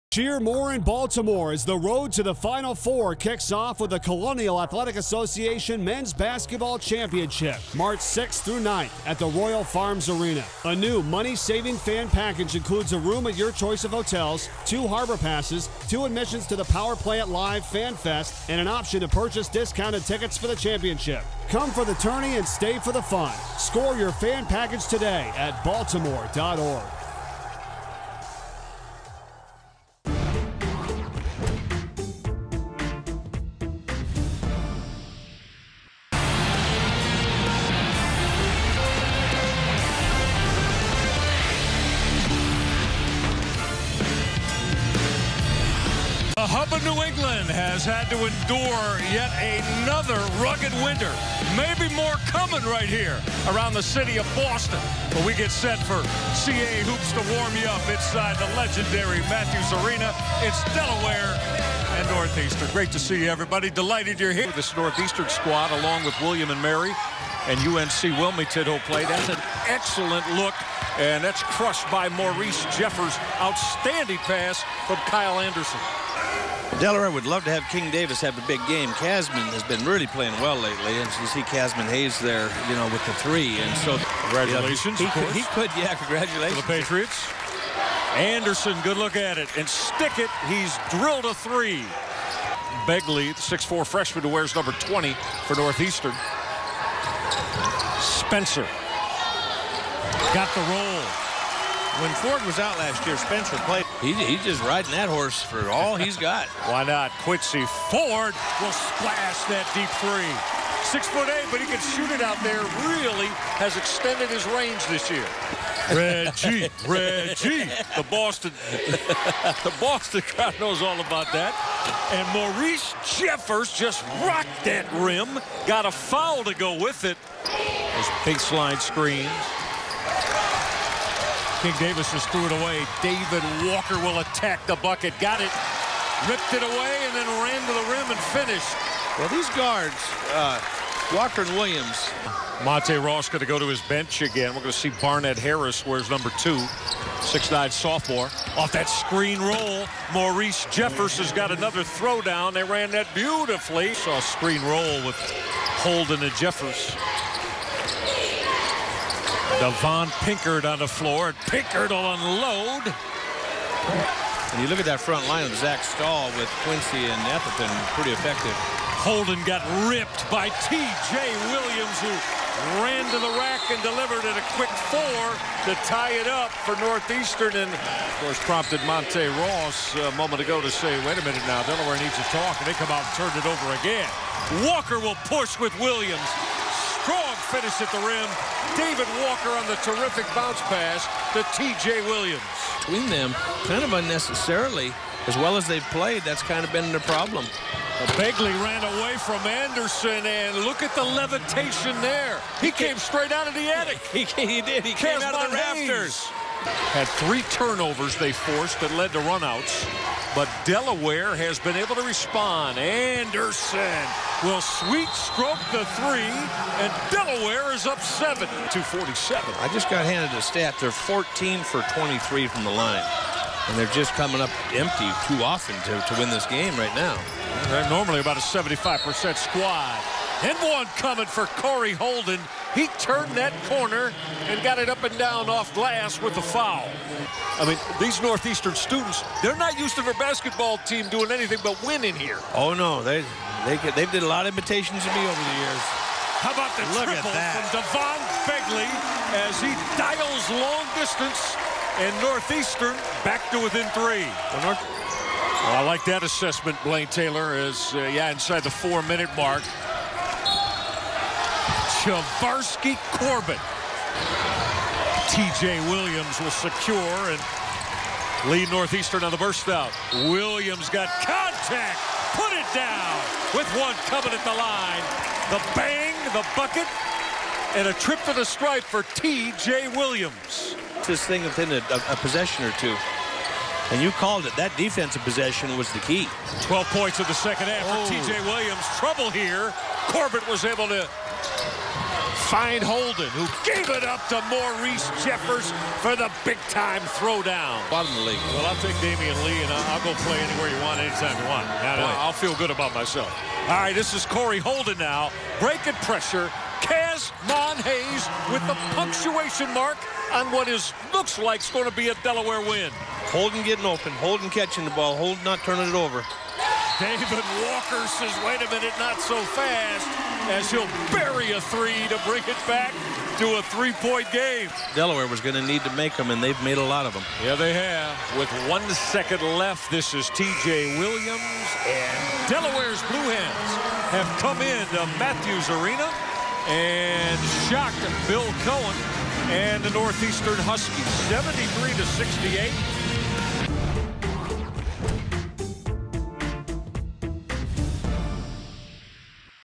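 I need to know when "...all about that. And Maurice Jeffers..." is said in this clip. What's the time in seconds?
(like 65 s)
120 s.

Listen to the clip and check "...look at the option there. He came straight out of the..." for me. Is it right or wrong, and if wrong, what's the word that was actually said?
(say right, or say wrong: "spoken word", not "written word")
wrong: "levitation", not "option".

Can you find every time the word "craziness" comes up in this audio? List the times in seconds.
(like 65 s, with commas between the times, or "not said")
not said.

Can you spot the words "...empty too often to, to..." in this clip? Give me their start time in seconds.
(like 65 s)
224 s.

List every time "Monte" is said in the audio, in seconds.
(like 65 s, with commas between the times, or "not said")
142 s, 178 s.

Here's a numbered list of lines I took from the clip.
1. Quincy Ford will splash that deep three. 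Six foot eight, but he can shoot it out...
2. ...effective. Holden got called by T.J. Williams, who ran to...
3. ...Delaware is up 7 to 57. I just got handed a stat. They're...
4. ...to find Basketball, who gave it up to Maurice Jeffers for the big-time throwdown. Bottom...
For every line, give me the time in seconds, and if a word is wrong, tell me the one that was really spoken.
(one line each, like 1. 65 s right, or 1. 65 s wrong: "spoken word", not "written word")
1. 107 s right
2. 168 s wrong: "ripped", not "called"
3. 217 s wrong: "47", not "57"
4. 290 s wrong: "Holden", not "Basketball".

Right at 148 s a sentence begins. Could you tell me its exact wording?
Off that screen roll, Maurice Jeffers has got another throwdown.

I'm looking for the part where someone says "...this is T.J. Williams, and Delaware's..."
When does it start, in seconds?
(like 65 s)
329 s.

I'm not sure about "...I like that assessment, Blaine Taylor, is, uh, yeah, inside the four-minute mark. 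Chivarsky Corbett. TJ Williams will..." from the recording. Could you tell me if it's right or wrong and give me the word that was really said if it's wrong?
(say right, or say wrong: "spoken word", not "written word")
right.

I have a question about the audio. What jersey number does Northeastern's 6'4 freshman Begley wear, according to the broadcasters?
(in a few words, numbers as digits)
20.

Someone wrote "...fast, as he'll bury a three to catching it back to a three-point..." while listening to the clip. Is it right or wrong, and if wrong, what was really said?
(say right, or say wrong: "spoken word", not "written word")
wrong: "bring", not "catching".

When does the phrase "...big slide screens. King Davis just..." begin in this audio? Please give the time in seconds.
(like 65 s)
128 s.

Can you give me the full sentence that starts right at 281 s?
This thing within a, a, possession or two.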